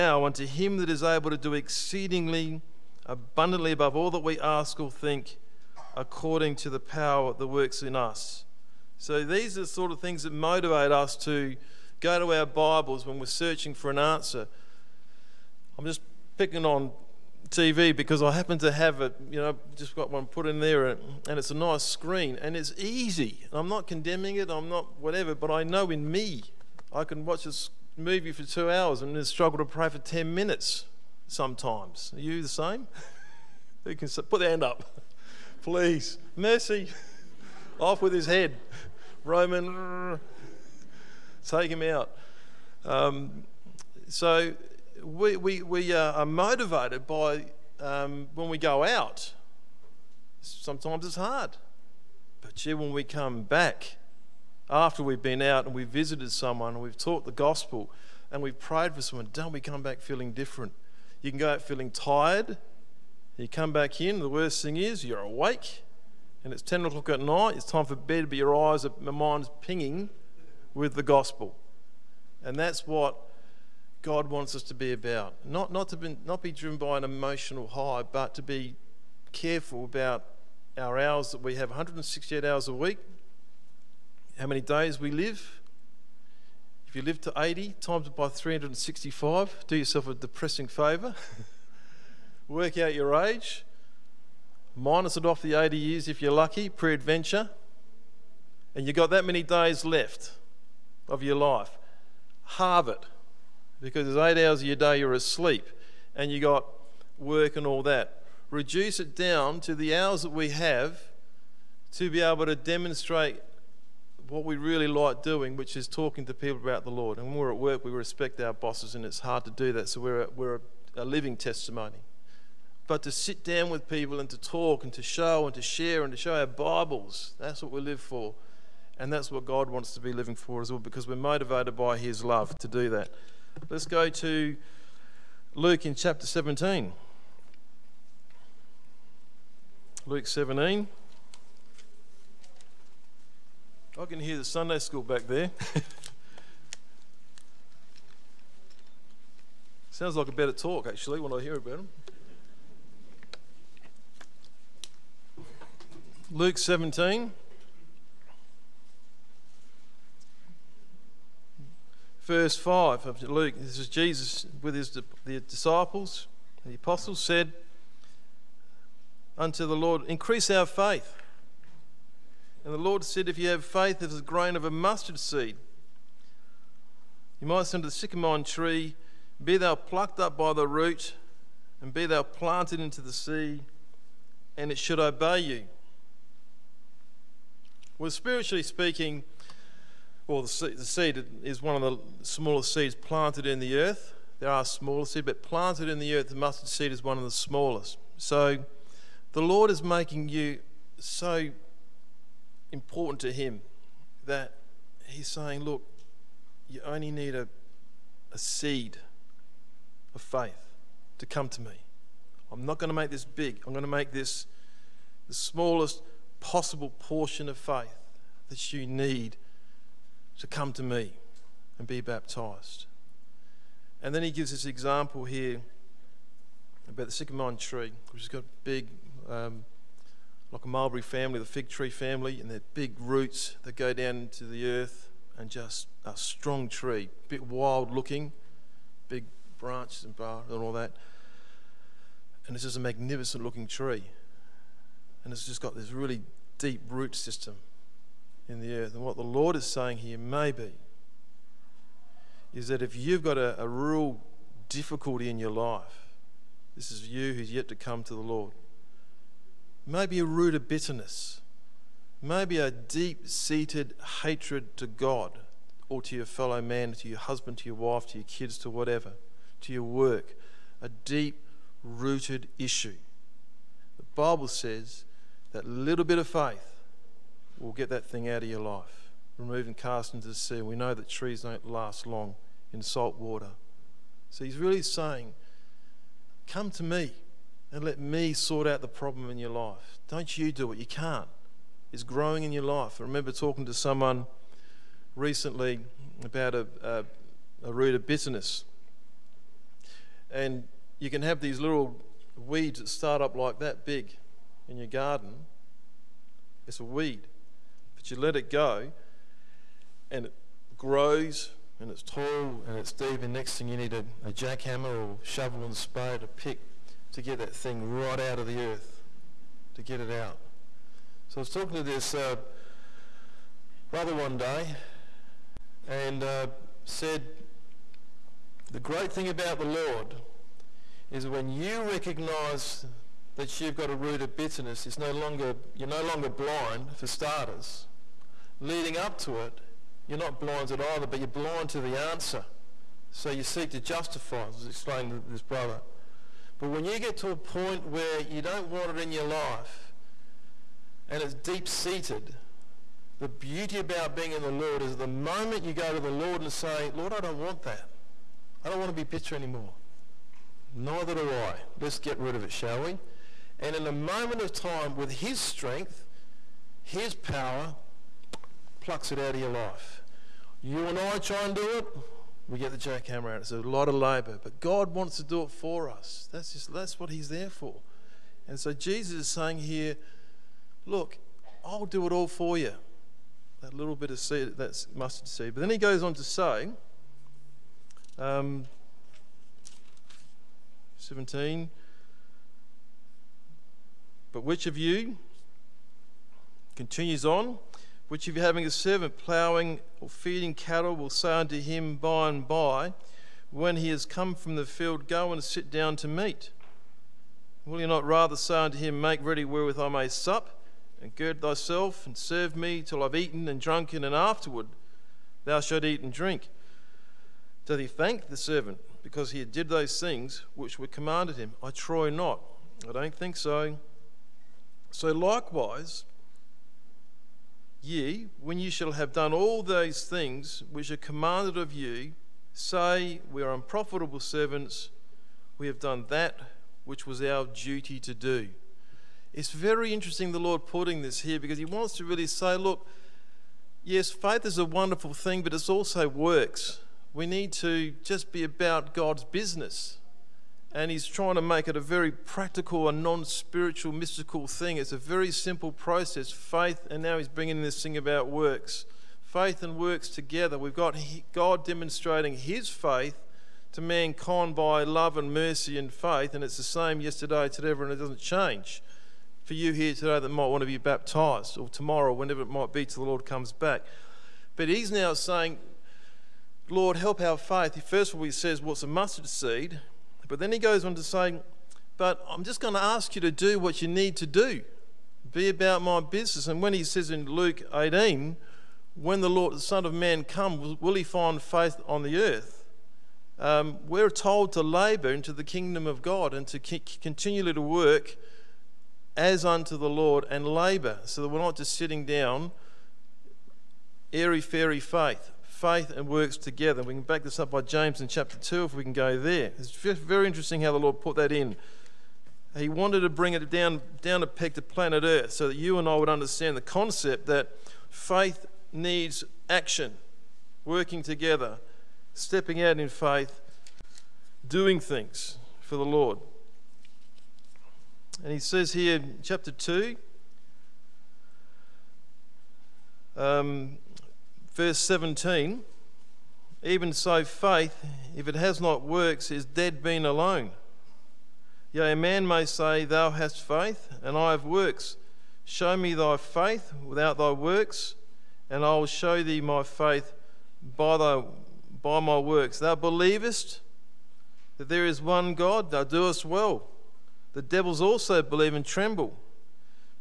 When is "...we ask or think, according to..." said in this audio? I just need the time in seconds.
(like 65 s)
4 s.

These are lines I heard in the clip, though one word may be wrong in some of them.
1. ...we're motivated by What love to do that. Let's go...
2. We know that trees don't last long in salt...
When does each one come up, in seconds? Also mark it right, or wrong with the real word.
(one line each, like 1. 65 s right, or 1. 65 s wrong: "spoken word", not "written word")
1. 131 s wrong: "His", not "What"
2. 280 s right.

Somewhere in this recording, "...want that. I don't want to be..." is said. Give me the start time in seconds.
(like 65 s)
357 s.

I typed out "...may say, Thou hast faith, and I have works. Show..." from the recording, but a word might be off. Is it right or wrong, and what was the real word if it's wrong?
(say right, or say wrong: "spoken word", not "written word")
right.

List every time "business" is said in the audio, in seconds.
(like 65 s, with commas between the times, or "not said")
449 s, 486 s.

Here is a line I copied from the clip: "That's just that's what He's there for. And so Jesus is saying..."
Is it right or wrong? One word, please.
right.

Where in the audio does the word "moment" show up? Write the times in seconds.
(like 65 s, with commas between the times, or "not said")
355 s, 363 s.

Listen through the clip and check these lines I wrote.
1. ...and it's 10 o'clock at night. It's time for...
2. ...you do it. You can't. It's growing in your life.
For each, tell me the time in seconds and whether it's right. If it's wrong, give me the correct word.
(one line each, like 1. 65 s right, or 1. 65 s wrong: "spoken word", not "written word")
1. 66 s right
2. 290 s right.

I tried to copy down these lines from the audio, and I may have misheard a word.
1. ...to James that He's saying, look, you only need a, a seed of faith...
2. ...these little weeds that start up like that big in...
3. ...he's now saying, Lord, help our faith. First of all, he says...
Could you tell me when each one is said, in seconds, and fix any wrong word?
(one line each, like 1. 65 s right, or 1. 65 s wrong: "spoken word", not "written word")
1. 203 s wrong: "Him", not "James"
2. 301 s right
3. 474 s right.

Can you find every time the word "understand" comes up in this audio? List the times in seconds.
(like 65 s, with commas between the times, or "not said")
516 s.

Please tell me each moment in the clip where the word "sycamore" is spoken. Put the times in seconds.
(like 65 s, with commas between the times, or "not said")
177 s, 227 s.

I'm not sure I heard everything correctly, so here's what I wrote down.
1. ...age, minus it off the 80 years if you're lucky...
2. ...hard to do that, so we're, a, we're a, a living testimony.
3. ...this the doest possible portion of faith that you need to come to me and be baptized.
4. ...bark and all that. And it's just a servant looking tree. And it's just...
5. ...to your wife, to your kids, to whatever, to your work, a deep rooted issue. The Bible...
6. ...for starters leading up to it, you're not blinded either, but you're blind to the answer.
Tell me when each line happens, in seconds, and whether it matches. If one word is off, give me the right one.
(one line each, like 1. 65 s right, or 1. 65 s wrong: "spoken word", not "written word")
1. 93 s right
2. 119 s right
3. 214 s wrong: "smallest", not "doest"
4. 240 s wrong: "magnificent", not "servant"
5. 267 s right
6. 336 s right.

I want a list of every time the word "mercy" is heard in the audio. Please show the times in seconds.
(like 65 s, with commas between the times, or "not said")
36 s, 465 s.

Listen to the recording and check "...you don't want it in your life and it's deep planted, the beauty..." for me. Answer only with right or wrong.
wrong.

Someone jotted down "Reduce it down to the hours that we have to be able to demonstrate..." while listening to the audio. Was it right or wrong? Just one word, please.
right.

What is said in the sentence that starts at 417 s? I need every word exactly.
Doth he thank the servant because he did those things which were commanded him?